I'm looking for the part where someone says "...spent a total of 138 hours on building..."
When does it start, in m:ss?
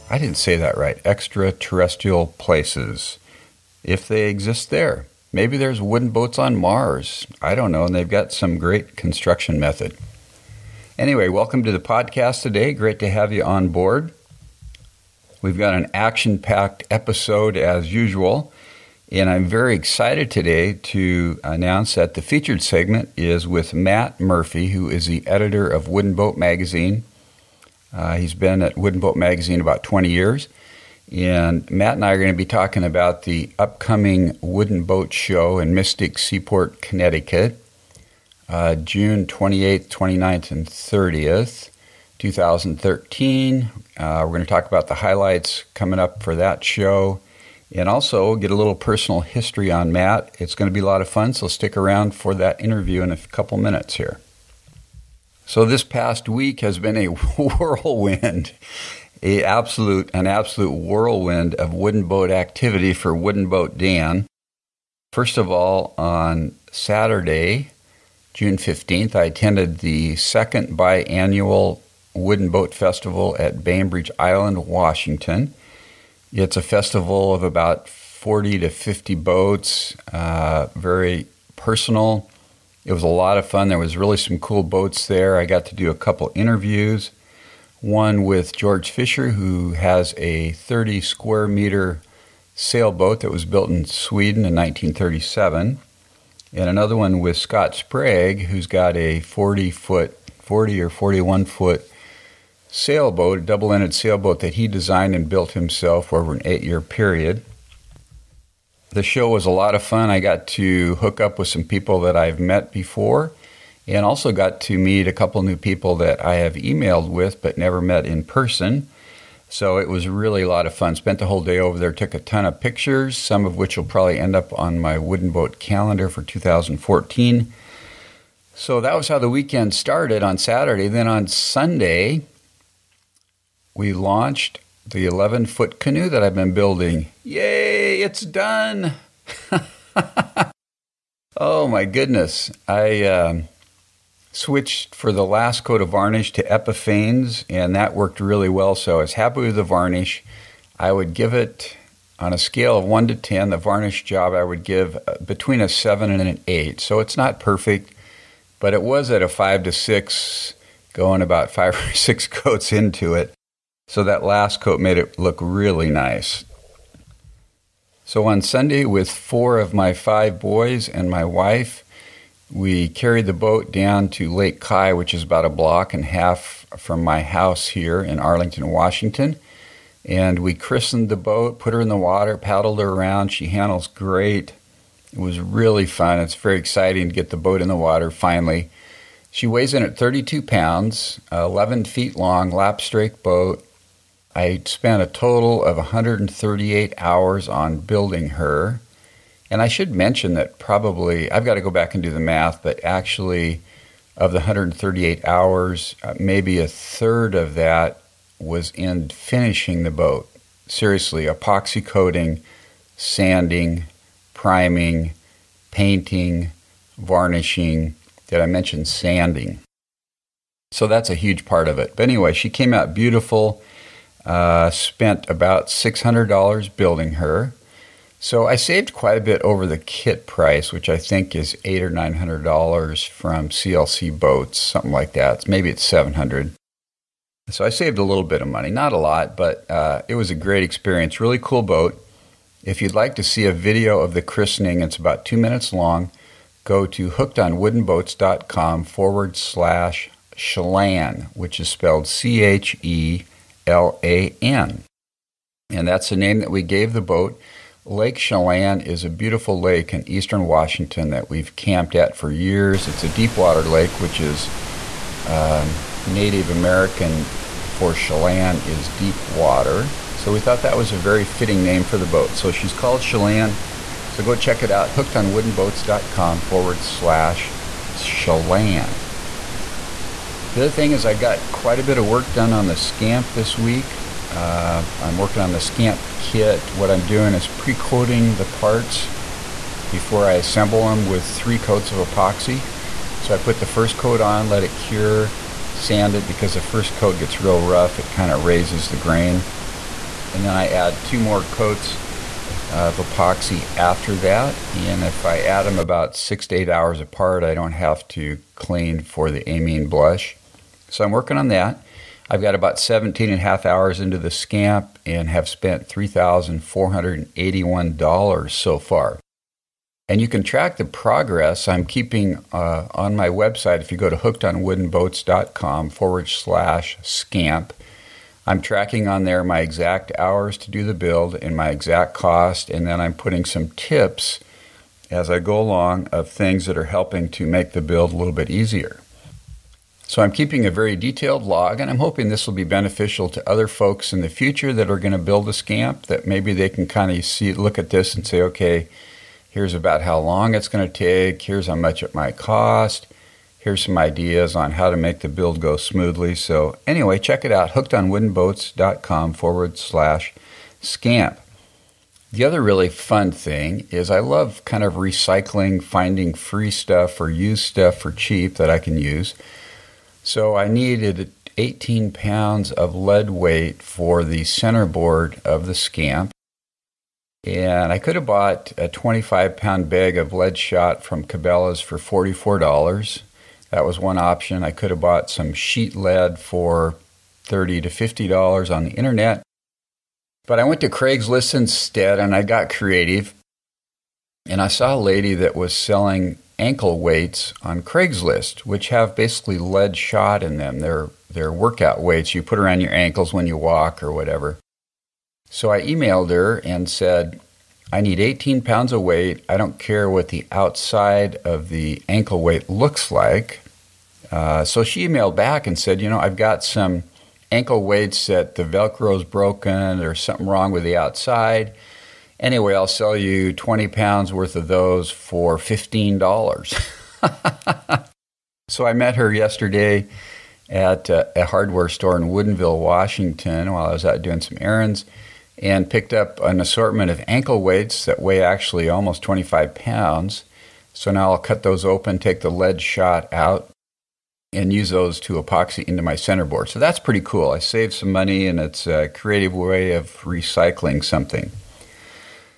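3:14.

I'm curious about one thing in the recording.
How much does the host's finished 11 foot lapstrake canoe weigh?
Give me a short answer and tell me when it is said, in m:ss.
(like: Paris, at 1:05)
32 pounds, at 3:09.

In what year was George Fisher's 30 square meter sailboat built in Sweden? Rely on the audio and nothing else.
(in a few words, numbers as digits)
1937.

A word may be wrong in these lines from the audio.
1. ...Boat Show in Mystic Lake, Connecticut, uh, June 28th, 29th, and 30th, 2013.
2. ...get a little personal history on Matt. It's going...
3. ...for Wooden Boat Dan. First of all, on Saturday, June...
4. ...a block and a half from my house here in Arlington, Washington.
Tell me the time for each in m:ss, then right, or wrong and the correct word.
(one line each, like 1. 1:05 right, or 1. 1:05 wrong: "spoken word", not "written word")
1. 0:34 wrong: "Seaport", not "Lake"
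2. 0:48 right
3. 1:02 right
4. 2:55 right.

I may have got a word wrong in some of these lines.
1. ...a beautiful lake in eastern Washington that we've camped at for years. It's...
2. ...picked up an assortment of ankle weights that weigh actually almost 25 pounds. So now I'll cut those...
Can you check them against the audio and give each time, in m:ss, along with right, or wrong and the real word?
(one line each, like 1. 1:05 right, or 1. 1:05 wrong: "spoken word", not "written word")
1. 4:19 right
2. 7:15 right.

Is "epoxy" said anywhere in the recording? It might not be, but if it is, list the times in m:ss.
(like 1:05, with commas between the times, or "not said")
3:31, 4:51, 5:02, 7:25.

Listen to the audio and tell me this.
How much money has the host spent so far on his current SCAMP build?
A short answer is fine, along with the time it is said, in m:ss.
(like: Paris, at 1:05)
$3,481, at 5:15.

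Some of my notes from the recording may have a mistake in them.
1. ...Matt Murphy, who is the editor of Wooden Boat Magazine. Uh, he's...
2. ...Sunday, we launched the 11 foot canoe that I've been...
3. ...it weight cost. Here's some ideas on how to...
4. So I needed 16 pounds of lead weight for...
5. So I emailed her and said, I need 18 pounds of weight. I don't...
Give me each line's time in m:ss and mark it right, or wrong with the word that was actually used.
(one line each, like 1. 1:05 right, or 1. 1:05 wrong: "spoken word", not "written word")
1. 0:23 right
2. 2:11 right
3. 5:52 wrong: "might", not "weight"
4. 6:10 wrong: "18", not "16"
5. 6:45 right.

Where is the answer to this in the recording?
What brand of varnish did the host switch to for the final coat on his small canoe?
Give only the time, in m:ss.
2:26.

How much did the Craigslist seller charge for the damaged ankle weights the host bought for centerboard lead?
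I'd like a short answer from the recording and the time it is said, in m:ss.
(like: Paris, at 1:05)
$15, at 7:05.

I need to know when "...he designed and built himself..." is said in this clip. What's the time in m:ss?
1:44.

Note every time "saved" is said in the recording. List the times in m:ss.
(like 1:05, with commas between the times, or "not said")
3:48, 3:57, 7:27.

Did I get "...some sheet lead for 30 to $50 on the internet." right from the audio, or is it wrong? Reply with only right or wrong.
right.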